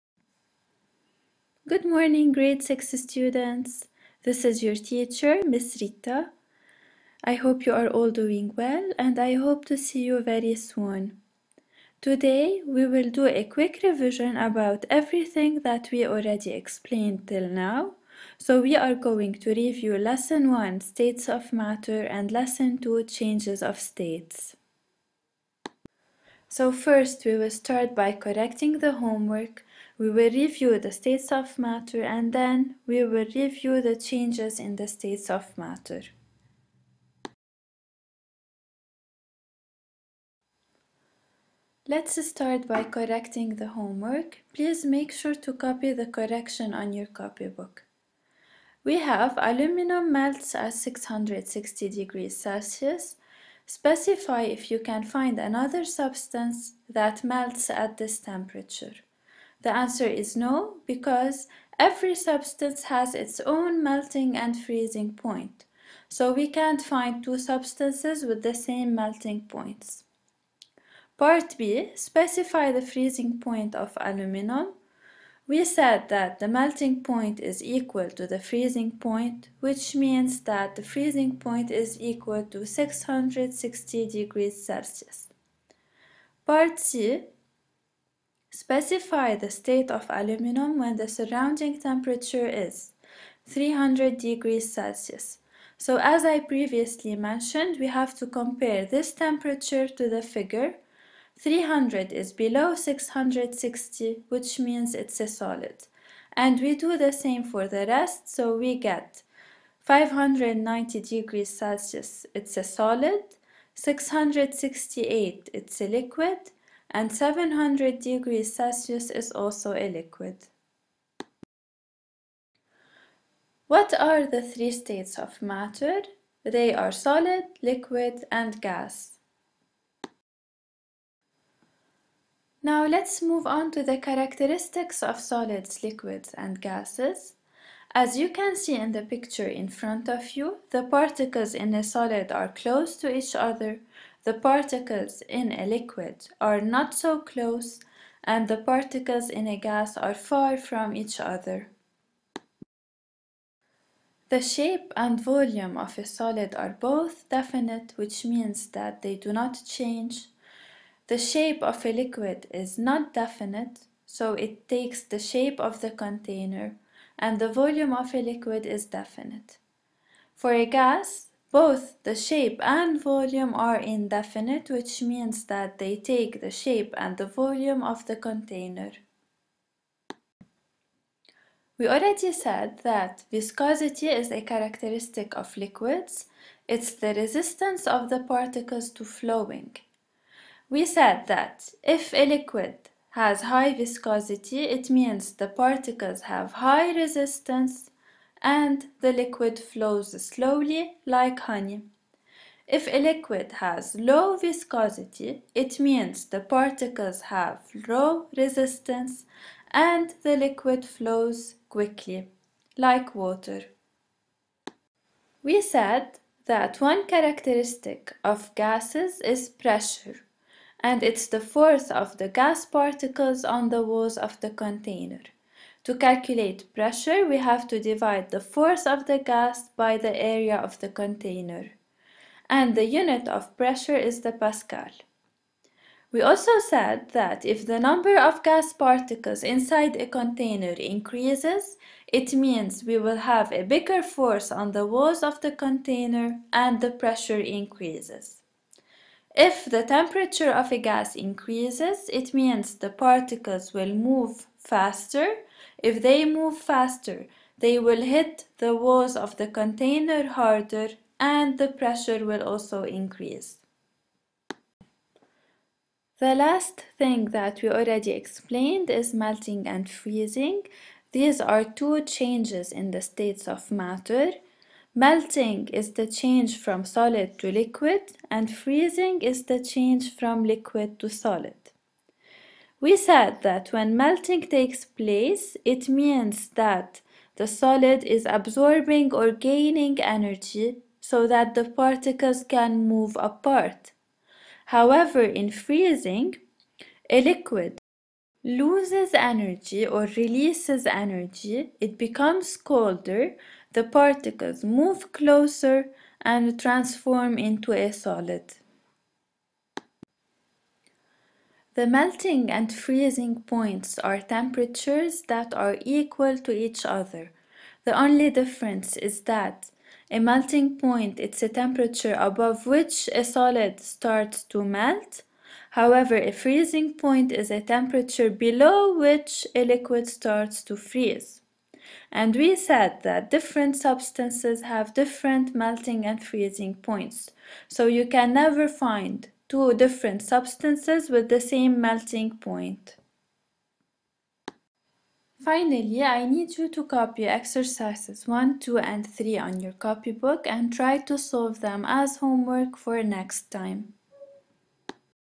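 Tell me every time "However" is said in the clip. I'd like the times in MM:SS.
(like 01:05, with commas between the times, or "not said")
04:54, 05:25.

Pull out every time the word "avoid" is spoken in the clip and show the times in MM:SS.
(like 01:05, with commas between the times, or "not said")
not said.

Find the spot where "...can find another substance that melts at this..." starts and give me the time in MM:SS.
00:54.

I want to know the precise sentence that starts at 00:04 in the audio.
This is your teacher, Miss Rita.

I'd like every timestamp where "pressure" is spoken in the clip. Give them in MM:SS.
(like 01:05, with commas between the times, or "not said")
03:39, 03:46, 03:53, 04:06, 04:21.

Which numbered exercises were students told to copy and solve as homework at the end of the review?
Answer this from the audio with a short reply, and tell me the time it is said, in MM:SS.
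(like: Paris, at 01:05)
1, 2 and 3, at 05:47.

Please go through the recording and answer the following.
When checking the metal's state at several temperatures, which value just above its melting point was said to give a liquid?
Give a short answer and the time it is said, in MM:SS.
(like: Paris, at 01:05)
668, at 01:53.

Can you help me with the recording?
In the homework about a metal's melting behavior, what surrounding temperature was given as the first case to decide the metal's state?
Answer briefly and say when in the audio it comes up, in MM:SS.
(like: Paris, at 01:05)
300 degrees Celsius, at 01:33.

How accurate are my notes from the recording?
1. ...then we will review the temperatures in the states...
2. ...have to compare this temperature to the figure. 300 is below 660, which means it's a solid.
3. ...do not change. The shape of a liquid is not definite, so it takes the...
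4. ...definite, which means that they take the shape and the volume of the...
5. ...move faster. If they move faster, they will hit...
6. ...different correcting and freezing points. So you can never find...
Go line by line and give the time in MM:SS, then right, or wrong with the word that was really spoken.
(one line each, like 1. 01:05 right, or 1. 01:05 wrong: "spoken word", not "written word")
1. 00:32 wrong: "changes", not "temperatures"
2. 01:37 right
3. 02:39 right
4. 02:53 wrong: "indefinite", not "definite"
5. 04:13 right
6. 05:34 wrong: "melting", not "correcting".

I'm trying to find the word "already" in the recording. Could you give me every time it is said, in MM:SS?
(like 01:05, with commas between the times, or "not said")
00:16, 03:01, 04:27.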